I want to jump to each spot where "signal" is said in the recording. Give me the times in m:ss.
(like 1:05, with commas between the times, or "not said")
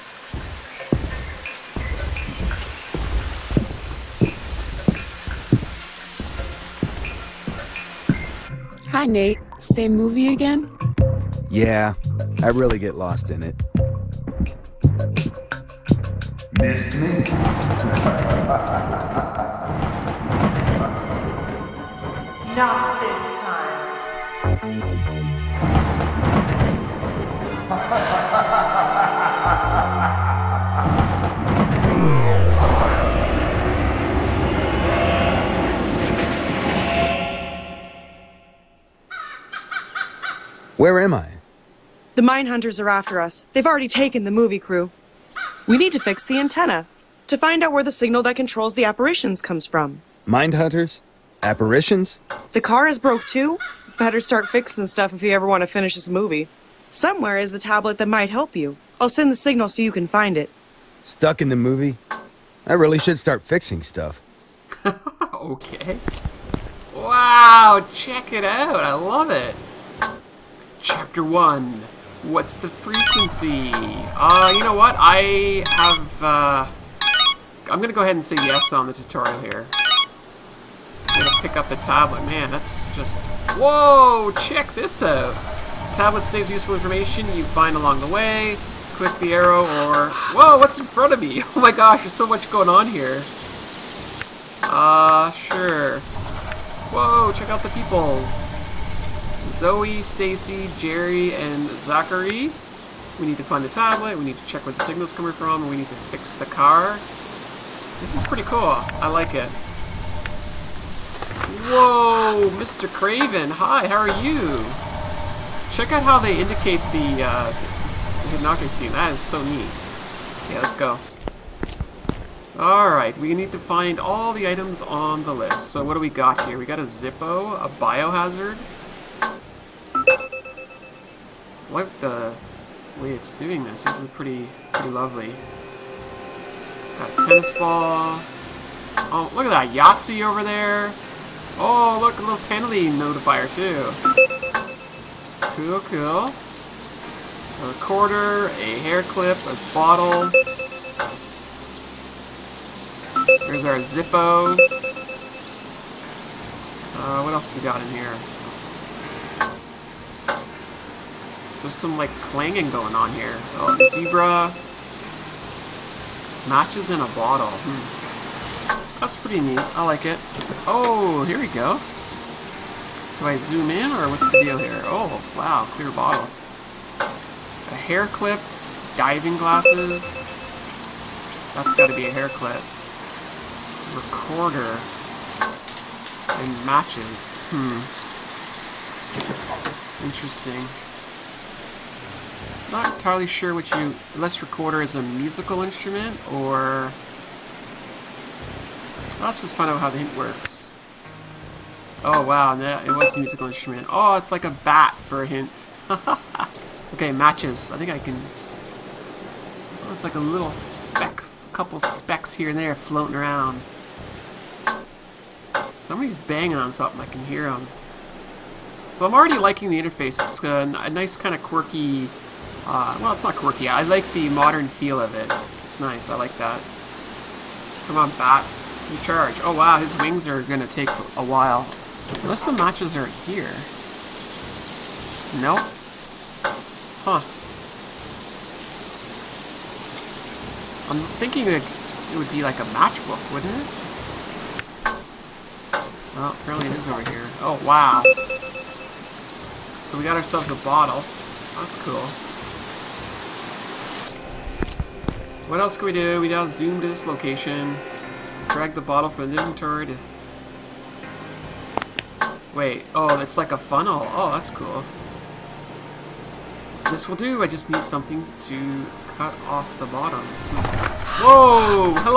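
0:47, 0:59, 1:44.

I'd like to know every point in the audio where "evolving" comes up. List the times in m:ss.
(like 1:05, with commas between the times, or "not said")
not said.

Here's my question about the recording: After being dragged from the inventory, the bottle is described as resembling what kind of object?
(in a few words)
A funnel.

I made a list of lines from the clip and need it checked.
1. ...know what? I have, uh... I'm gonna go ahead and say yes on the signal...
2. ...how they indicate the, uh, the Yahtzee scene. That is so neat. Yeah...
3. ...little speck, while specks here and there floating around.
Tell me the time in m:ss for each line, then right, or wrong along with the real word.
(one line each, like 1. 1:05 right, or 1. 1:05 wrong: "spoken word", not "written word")
1. 1:14 wrong: "tutorial", not "signal"
2. 1:56 wrong: "Hinaka", not "Yahtzee"
3. 3:30 wrong: "couple", not "while".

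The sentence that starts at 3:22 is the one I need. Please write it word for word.
Oh wow, it was the musical instrument.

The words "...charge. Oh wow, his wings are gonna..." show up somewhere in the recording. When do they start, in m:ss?
3:49.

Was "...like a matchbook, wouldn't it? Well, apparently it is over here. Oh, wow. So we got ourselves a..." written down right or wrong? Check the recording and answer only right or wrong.
right.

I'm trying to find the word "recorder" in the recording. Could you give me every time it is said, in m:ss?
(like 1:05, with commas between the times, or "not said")
3:03, 3:14.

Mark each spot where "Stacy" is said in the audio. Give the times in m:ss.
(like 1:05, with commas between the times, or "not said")
1:40.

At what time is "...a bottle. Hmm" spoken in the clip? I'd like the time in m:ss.
2:46.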